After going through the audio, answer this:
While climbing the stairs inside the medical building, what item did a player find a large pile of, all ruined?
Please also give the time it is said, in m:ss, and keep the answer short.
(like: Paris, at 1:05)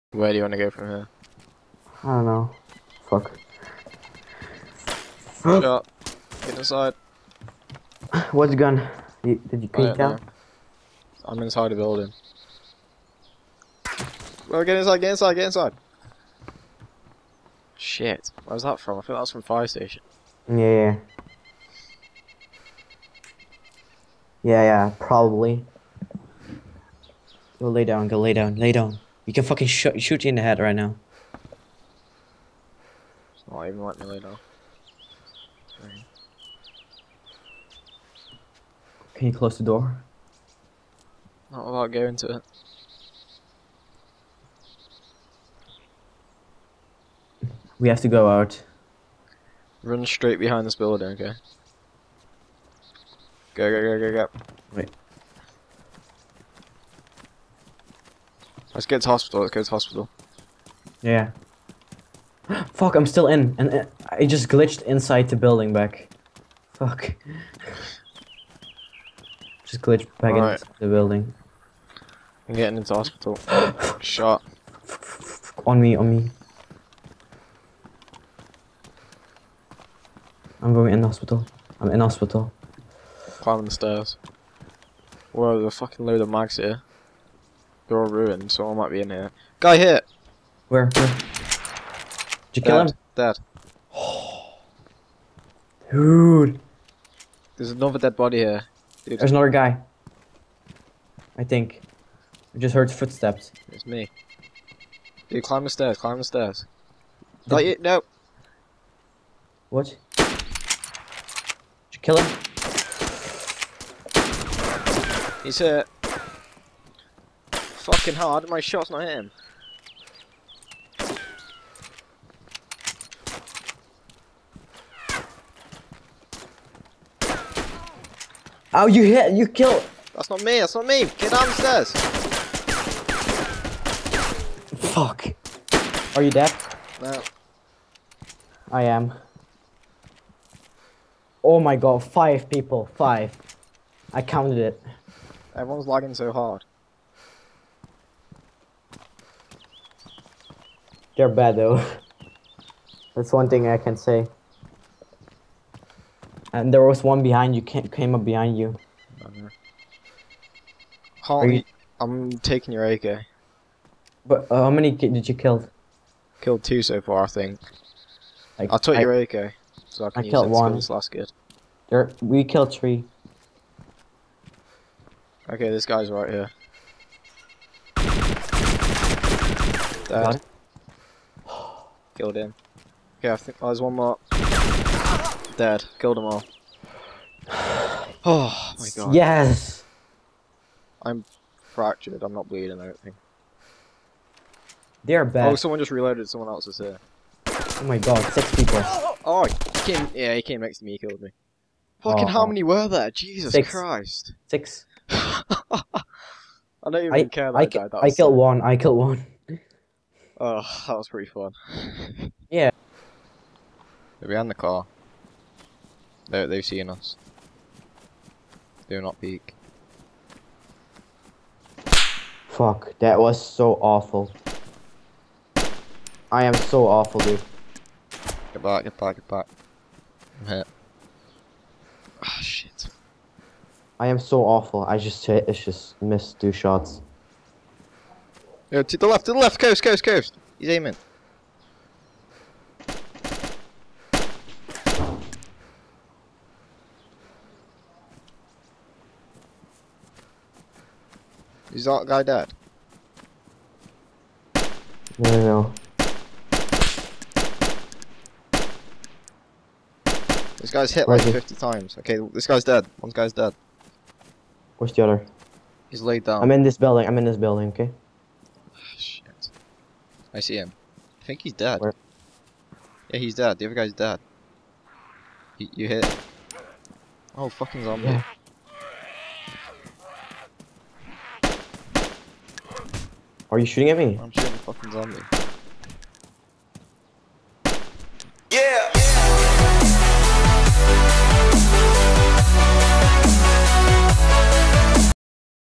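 mags, at 1:26.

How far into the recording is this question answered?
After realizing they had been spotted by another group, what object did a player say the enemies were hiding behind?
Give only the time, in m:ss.
3:34.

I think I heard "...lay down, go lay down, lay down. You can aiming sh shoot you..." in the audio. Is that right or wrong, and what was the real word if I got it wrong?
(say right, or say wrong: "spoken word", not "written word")
wrong: "fucking", not "aiming".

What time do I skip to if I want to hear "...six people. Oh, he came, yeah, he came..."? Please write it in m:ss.
3:18.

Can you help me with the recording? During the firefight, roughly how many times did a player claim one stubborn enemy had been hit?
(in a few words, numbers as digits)
50.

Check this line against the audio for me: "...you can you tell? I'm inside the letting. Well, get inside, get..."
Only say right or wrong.
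wrong.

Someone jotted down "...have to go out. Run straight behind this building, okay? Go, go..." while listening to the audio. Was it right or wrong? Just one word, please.
right.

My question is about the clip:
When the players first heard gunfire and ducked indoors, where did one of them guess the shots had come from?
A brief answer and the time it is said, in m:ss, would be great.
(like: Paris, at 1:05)
fire station, at 0:19.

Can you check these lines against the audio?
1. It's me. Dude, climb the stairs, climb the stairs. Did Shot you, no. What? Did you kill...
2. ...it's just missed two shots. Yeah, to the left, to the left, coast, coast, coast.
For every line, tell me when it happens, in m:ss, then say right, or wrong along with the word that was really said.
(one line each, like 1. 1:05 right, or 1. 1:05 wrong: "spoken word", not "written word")
1. 1:43 wrong: "Not", not "Shot"
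2. 3:55 right.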